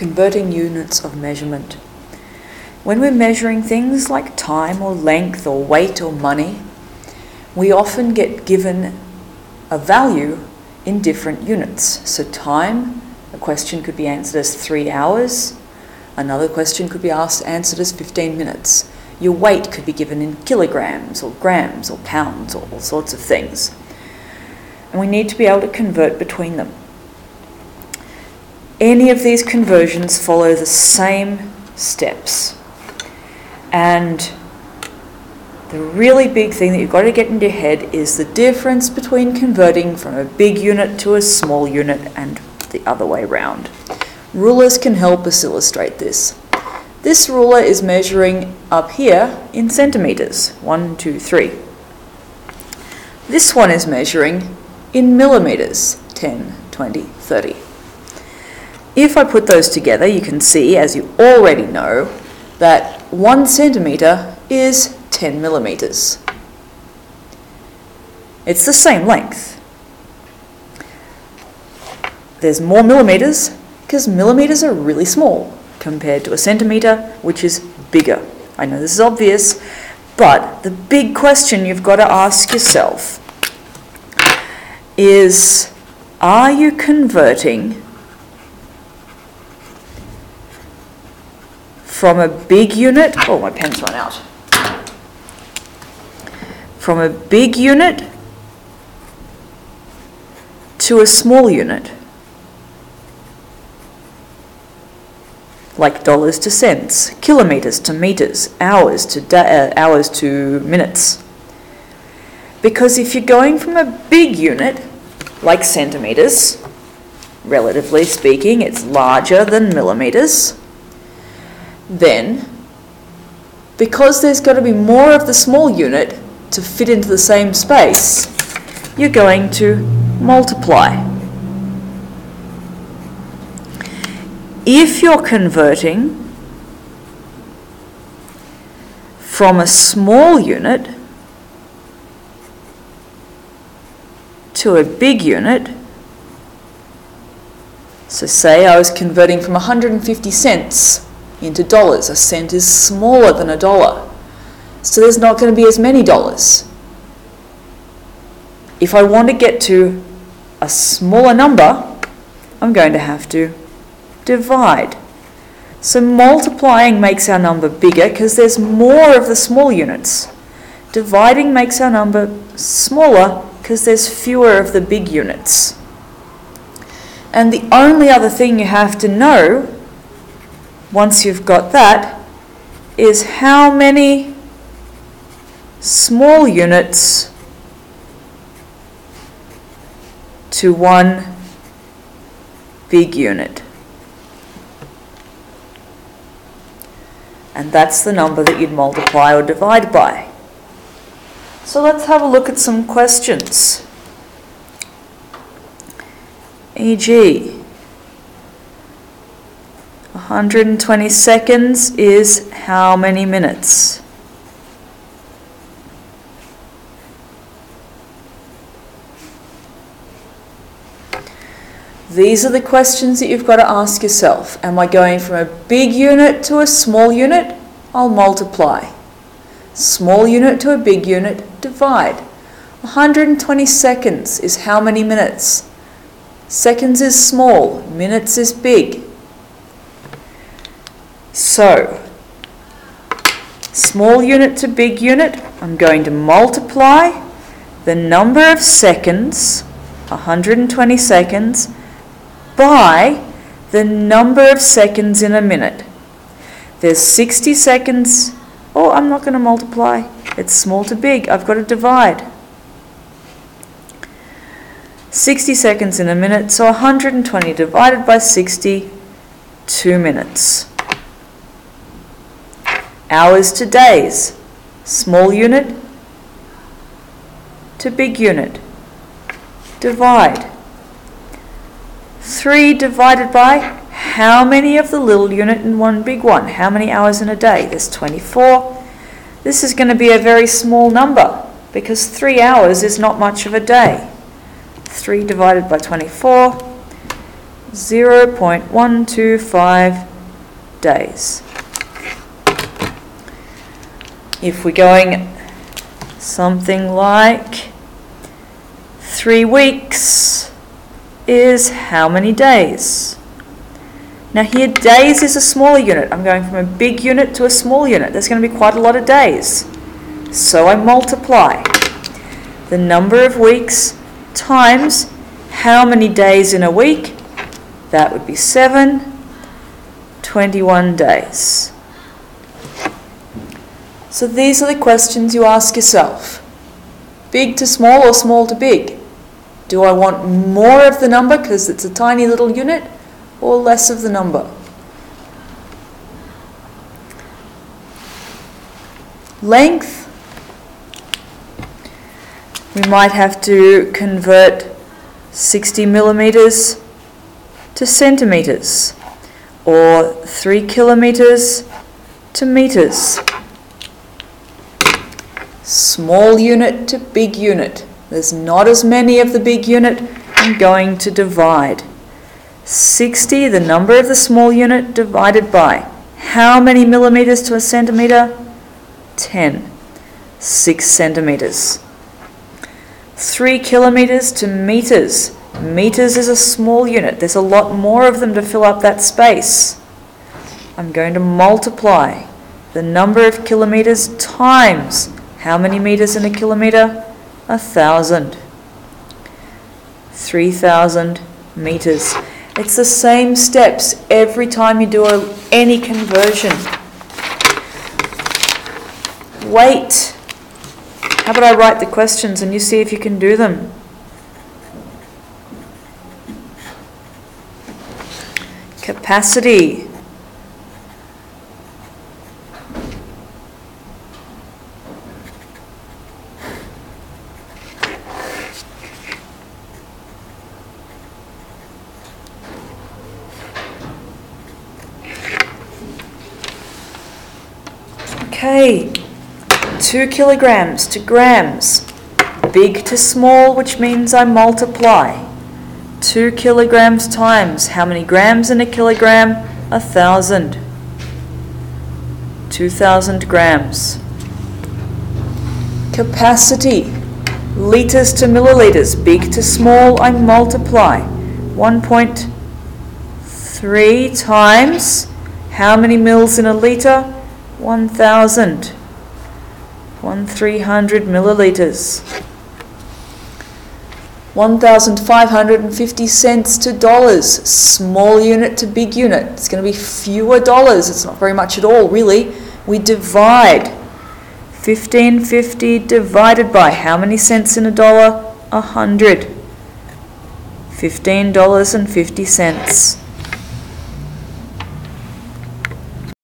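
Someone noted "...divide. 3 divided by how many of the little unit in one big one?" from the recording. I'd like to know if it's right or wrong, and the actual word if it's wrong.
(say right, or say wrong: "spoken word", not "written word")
right.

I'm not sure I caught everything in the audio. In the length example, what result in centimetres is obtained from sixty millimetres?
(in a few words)
6 centimetres.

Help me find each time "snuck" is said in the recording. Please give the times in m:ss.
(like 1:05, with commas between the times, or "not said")
not said.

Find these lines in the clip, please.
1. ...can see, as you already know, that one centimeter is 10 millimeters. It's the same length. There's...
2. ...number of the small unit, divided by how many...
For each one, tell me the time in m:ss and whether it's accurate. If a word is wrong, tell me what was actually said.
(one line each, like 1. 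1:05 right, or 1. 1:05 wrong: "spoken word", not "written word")
1. 1:00 right
2. 6:13 right.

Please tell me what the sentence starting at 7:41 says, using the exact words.
1.3 times how many mils in a liter?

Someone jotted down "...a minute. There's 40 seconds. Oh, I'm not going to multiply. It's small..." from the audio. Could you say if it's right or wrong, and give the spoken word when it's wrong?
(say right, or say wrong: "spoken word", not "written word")
wrong: "60", not "40".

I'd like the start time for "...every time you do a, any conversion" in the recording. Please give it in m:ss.
6:44.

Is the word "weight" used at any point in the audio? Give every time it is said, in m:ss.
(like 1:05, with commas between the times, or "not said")
0:05, 0:19, 6:49.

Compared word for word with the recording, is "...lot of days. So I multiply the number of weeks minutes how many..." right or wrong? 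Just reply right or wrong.
wrong.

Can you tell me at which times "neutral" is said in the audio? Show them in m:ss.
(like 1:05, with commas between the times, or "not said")
not said.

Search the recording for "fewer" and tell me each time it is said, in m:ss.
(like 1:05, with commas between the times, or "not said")
2:54, 7:59.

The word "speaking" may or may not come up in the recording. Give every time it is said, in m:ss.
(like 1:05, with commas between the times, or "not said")
1:58.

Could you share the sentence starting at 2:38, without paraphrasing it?
If I want to get to a smaller number, I'm going to have to divide.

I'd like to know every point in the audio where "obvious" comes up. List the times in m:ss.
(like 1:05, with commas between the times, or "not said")
1:18.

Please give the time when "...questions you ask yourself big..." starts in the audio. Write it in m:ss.
5:34.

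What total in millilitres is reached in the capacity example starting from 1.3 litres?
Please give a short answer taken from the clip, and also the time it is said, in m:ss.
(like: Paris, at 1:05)
1,300 millilitres, at 7:50.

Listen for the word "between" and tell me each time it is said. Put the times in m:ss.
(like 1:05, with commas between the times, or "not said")
0:26, 0:38.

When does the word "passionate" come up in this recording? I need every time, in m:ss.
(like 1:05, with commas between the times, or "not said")
not said.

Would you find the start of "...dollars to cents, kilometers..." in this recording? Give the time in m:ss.
1:46.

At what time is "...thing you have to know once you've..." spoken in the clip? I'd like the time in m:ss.
2:58.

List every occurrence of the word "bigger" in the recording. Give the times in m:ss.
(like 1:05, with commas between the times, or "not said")
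1:17, 2:47.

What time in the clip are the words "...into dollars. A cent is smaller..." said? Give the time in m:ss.
2:31.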